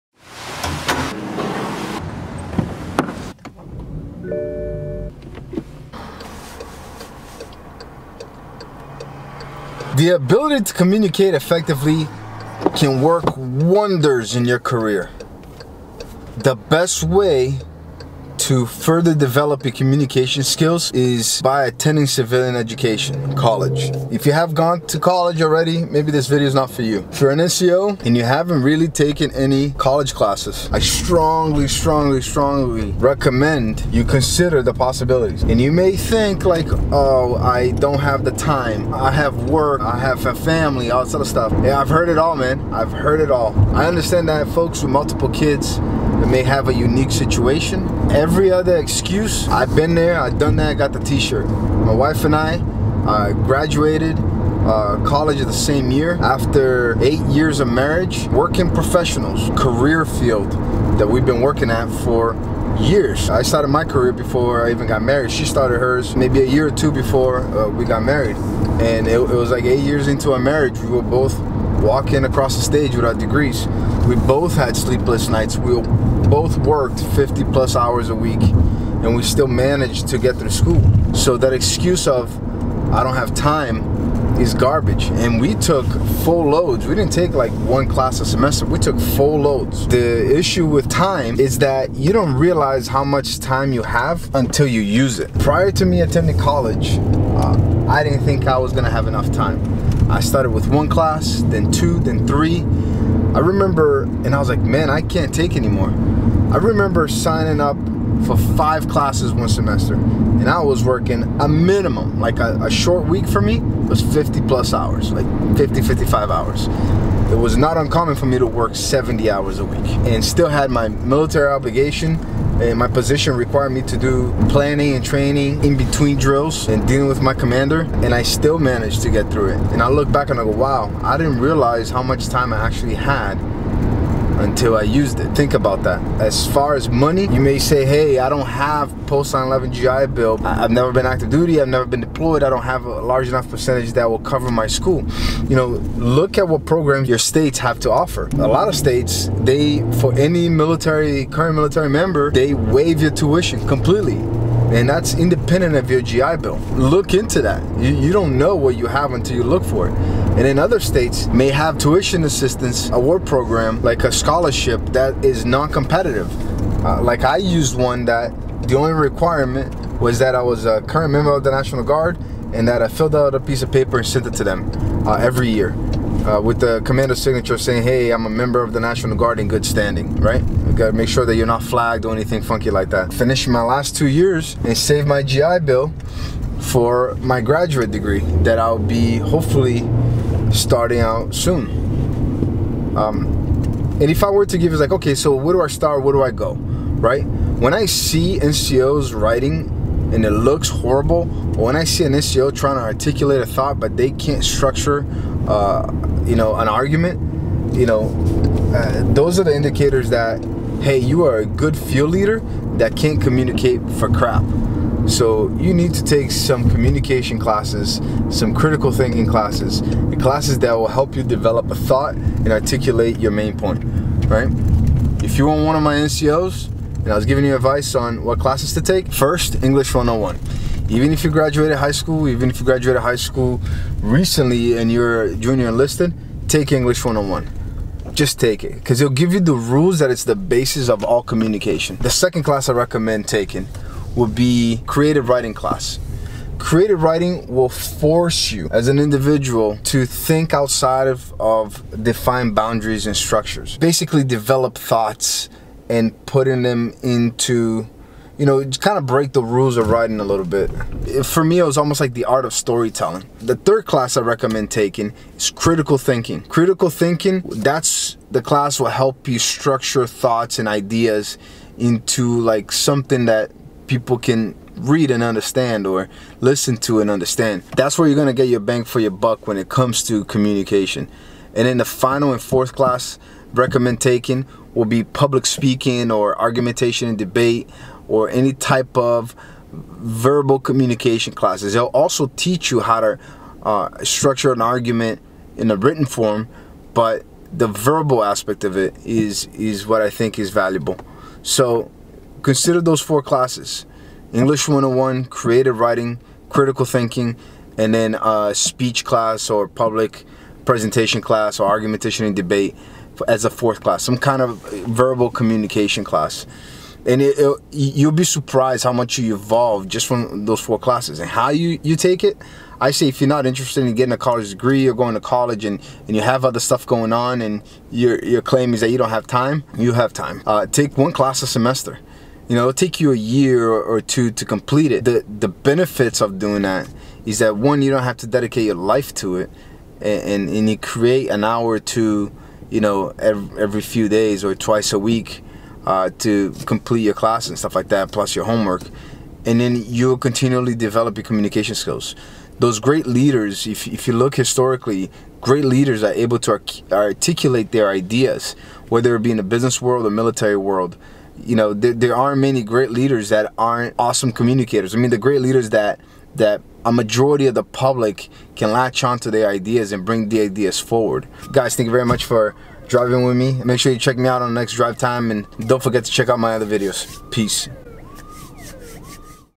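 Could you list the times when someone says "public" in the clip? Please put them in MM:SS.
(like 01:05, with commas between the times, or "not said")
04:45, 05:09, 06:07.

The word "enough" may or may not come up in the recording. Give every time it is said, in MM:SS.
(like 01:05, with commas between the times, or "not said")
01:39, 02:23.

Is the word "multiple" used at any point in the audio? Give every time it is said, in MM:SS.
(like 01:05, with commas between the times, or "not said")
00:44.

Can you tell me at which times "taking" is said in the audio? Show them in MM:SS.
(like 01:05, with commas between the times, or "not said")
04:03, 04:24, 04:43.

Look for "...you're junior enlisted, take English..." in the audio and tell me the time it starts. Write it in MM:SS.
03:54.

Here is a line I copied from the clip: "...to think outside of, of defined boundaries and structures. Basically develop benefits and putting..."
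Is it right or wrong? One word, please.
wrong.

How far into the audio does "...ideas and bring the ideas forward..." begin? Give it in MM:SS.
06:09.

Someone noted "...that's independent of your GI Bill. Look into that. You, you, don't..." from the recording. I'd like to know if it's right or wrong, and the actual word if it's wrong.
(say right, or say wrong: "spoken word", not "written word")
right.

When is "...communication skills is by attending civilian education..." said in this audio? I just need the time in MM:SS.
00:19.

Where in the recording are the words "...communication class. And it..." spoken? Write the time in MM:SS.
05:15.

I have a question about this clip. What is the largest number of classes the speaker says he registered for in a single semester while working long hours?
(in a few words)
5.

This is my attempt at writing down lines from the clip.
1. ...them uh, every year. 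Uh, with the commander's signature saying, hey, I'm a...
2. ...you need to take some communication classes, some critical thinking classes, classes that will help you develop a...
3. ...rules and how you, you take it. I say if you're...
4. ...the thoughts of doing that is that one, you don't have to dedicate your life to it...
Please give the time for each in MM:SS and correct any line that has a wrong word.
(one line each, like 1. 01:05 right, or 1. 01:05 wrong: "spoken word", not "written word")
1. 02:54 right
2. 03:35 right
3. 05:20 wrong: "classes", not "rules"
4. 05:35 wrong: "benefits", not "thoughts".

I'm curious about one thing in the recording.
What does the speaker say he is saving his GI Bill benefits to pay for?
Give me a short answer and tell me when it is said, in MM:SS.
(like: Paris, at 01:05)
graduate degree, at 03:07.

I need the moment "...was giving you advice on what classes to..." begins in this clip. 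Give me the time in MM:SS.
03:47.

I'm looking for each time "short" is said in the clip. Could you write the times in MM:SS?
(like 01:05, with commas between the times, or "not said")
01:52.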